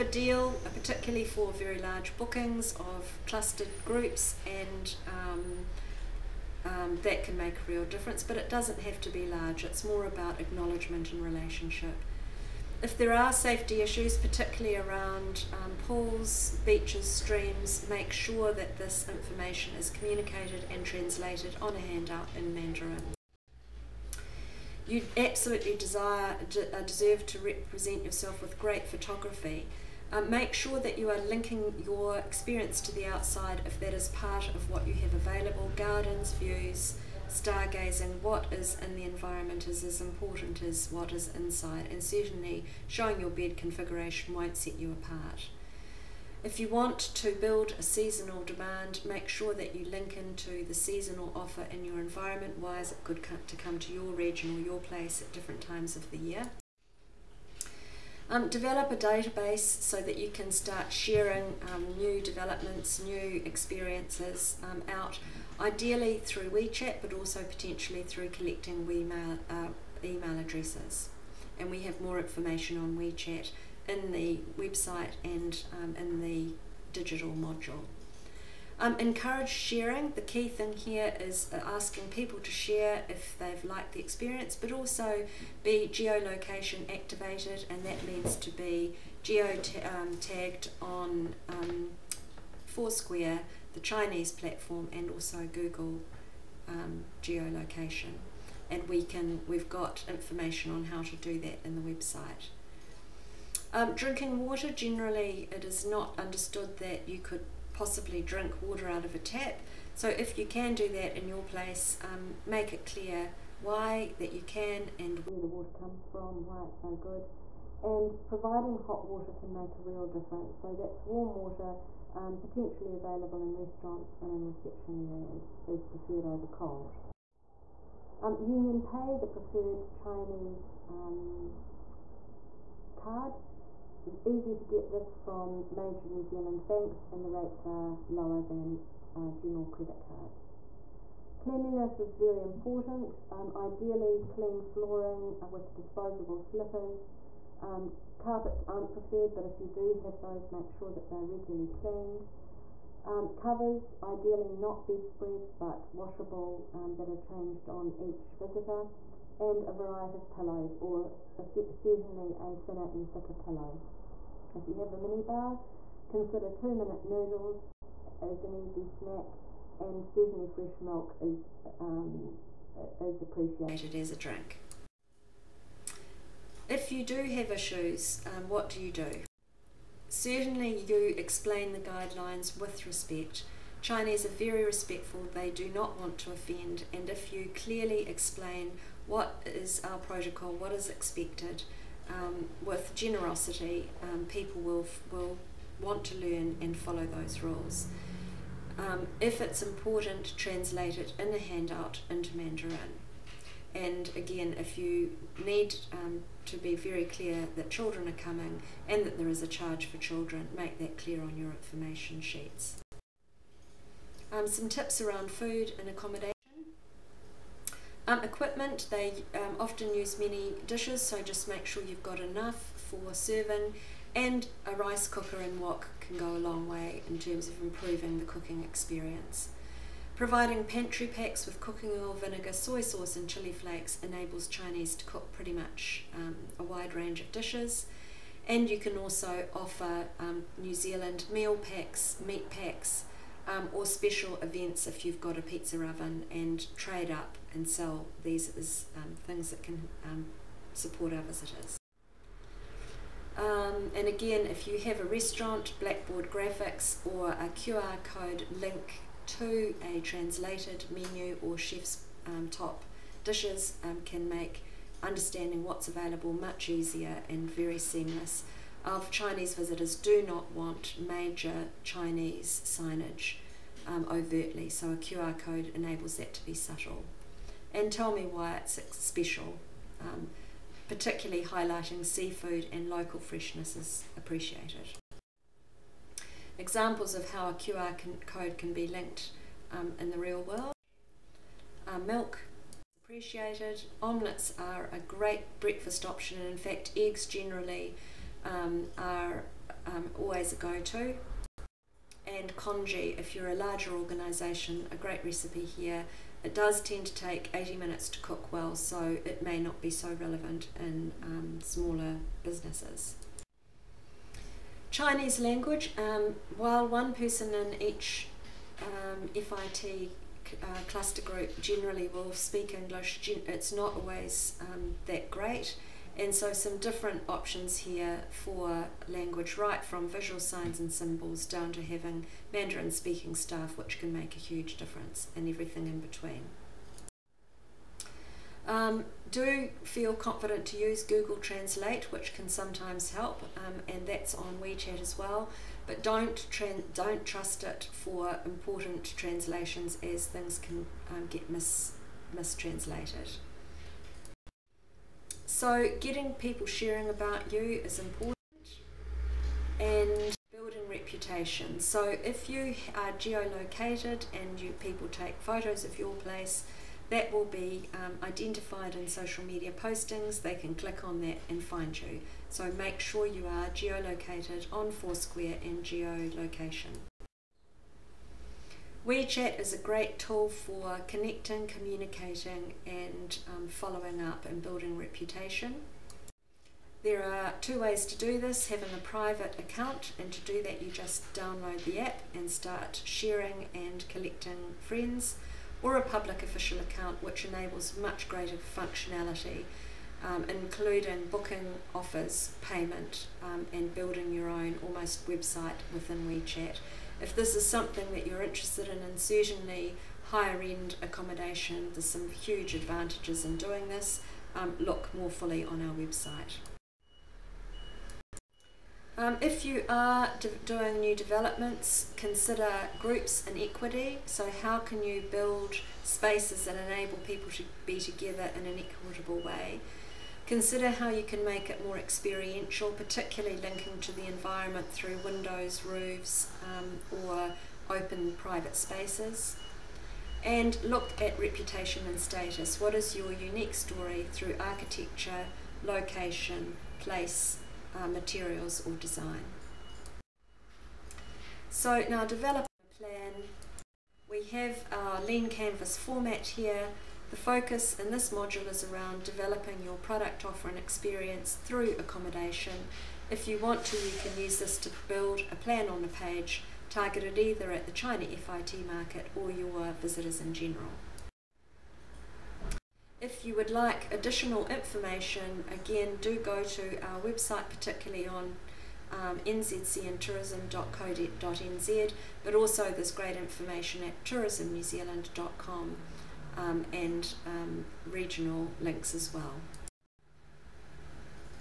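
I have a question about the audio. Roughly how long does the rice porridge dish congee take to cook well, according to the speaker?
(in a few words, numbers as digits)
80 minutes.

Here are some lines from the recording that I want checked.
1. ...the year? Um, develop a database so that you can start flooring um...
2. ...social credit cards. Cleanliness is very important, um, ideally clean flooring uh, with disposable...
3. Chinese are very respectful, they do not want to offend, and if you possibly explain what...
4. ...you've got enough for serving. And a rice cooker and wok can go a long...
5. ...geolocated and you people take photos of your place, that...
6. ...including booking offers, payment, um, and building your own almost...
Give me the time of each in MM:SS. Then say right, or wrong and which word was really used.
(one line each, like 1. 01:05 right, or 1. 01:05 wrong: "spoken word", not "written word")
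1. 00:56 wrong: "sharing", not "flooring"
2. 02:19 wrong: "general", not "social"
3. 03:03 wrong: "clearly", not "possibly"
4. 03:41 right
5. 06:03 right
6. 06:40 right.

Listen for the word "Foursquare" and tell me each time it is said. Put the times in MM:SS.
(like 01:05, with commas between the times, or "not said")
01:32, 06:14.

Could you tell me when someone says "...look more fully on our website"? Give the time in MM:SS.
06:54.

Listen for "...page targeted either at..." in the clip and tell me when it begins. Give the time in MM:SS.
07:46.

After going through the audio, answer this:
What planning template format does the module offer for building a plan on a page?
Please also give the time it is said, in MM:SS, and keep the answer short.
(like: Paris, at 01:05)
Lean canvas, at 07:35.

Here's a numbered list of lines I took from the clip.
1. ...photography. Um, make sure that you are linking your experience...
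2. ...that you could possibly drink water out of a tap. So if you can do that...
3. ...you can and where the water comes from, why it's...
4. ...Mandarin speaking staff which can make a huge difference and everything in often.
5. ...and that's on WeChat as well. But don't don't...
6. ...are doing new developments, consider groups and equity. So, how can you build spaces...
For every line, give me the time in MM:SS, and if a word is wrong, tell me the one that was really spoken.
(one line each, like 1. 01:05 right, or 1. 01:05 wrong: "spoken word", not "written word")
1. 00:28 right
2. 01:46 right
3. 01:54 right
4. 05:32 wrong: "between", not "often"
5. 05:43 right
6. 06:59 right.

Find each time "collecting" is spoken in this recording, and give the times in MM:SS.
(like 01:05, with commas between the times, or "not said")
01:08, 06:34.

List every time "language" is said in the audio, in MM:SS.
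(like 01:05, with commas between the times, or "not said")
05:15, 05:29.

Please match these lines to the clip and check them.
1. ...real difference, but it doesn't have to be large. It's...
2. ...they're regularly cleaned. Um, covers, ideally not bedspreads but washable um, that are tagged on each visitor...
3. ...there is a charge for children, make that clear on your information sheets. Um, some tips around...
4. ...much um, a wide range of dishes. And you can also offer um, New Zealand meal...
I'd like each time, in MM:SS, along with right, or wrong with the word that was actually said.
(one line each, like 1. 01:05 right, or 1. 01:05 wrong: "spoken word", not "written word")
1. 00:07 right
2. 02:31 wrong: "changed", not "tagged"
3. 03:29 right
4. 03:55 right.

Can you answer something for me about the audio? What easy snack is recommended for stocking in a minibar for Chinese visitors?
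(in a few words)
Two minute noodles.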